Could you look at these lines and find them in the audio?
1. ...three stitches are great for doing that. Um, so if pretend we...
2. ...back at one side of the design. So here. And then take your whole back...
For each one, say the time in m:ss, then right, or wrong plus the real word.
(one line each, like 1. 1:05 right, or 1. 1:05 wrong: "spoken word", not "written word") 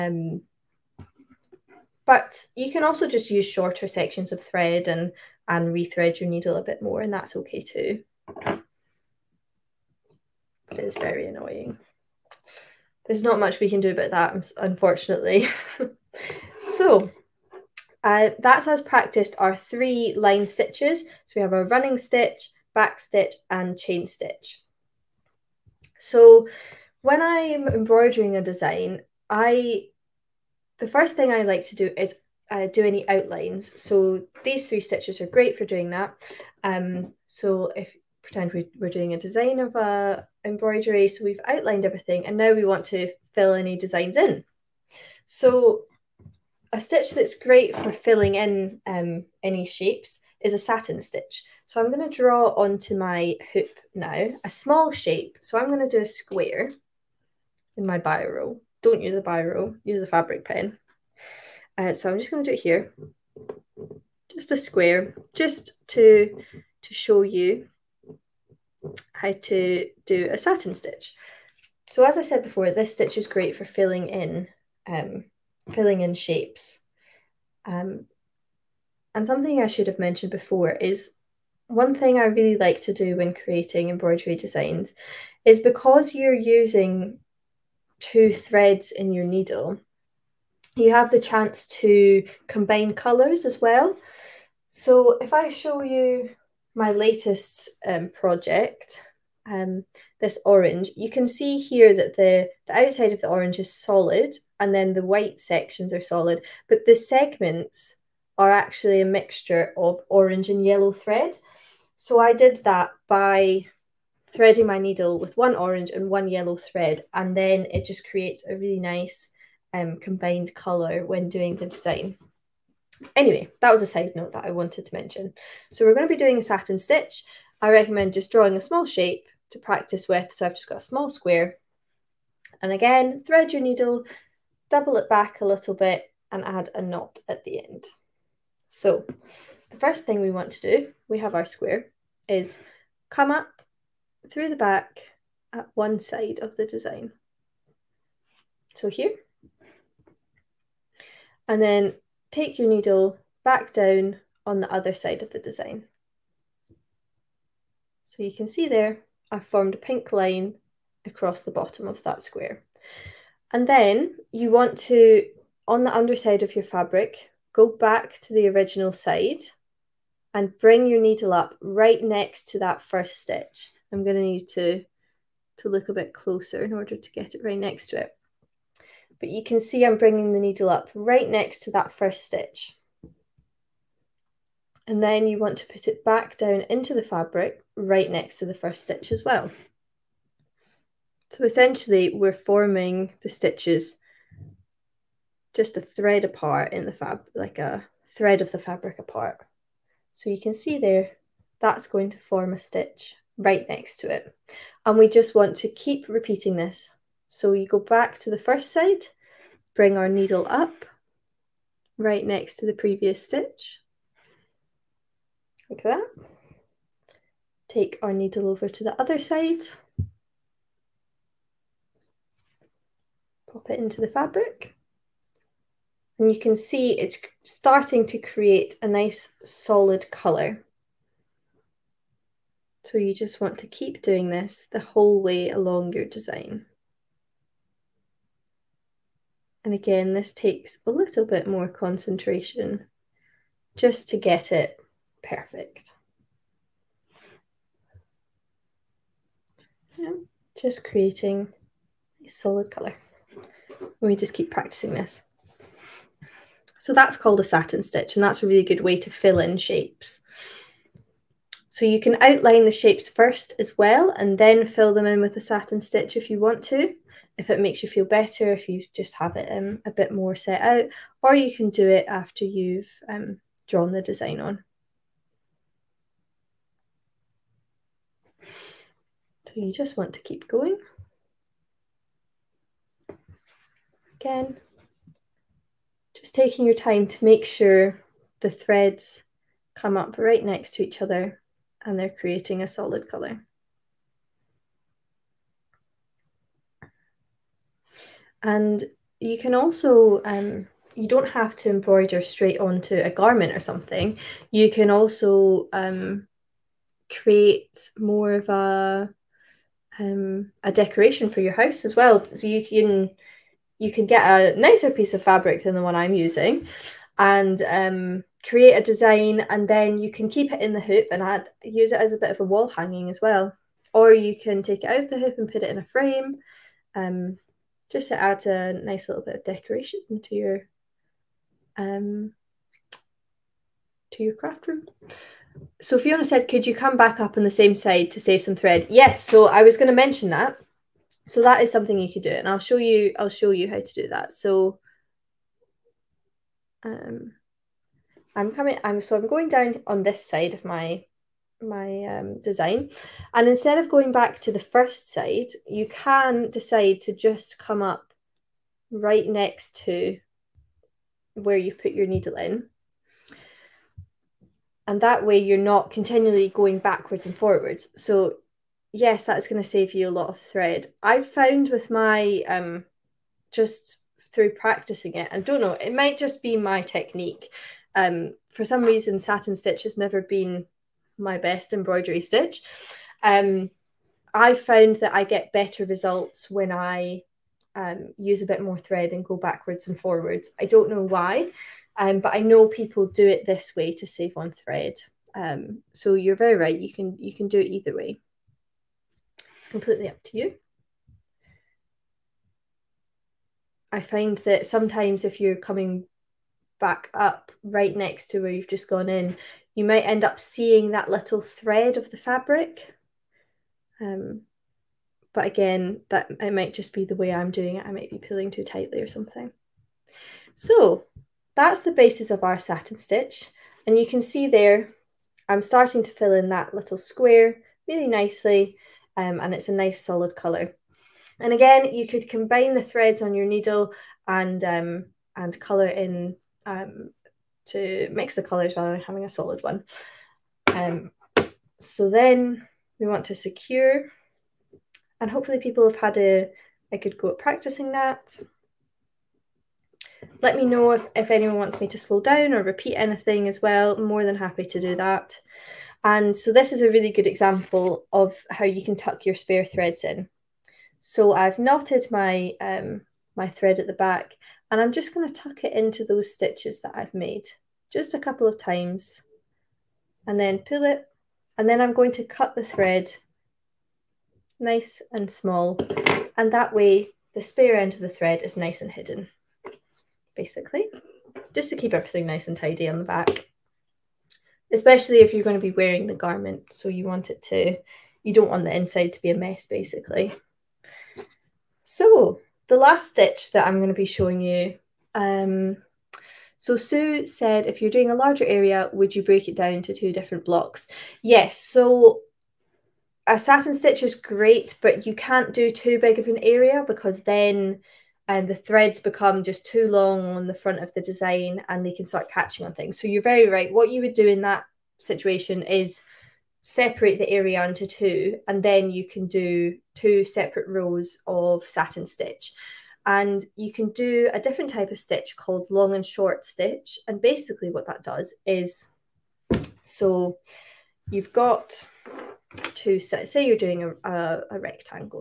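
1. 0:34 right
2. 2:24 wrong: "needle", not "whole".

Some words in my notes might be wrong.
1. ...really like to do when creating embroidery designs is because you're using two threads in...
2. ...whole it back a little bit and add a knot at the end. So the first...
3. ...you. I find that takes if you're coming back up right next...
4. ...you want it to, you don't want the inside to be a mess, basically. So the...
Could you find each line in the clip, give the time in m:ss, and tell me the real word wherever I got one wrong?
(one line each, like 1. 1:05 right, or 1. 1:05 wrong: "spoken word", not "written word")
1. 1:22 right
2. 2:14 wrong: "double", not "whole"
3. 6:40 wrong: "sometimes", not "takes"
4. 8:06 right.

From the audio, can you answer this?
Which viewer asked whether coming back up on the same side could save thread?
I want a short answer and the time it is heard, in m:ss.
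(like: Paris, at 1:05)
Fiona, at 5:35.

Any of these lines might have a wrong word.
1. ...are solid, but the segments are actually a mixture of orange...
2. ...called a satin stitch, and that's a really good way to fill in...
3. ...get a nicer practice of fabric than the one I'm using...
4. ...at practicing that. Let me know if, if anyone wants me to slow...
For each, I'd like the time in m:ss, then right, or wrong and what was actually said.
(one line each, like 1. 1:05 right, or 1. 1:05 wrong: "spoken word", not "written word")
1. 1:45 right
2. 4:17 right
3. 5:14 wrong: "piece", not "practice"
4. 7:27 right.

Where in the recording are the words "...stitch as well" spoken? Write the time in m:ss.
3:08.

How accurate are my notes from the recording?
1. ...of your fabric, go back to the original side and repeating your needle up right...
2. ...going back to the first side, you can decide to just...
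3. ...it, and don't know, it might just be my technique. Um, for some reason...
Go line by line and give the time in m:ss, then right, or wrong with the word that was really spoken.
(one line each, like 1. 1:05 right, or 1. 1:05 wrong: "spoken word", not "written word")
1. 2:46 wrong: "bring", not "repeating"
2. 5:53 right
3. 6:15 right.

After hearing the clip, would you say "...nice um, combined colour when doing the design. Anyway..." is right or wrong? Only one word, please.
right.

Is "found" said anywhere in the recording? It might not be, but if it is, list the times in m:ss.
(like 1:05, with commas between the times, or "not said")
6:11, 6:24.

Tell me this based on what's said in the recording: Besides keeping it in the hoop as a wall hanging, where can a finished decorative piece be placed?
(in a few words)
a frame.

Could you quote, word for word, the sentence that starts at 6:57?
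I might be pulling too tightly or something.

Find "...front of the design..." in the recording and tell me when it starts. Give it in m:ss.
8:30.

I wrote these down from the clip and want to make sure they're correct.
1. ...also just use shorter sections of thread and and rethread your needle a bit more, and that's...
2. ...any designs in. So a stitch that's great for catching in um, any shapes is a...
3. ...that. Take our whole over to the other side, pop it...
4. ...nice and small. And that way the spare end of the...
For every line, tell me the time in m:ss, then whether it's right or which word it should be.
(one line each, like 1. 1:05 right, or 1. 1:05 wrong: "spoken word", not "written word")
1. 0:02 right
2. 0:43 wrong: "filling", not "catching"
3. 3:35 wrong: "needle", not "whole"
4. 7:54 right.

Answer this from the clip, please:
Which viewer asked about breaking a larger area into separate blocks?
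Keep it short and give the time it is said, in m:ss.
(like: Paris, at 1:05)
Sue, at 8:16.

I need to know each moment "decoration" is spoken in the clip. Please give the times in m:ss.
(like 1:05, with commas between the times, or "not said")
5:10, 5:29.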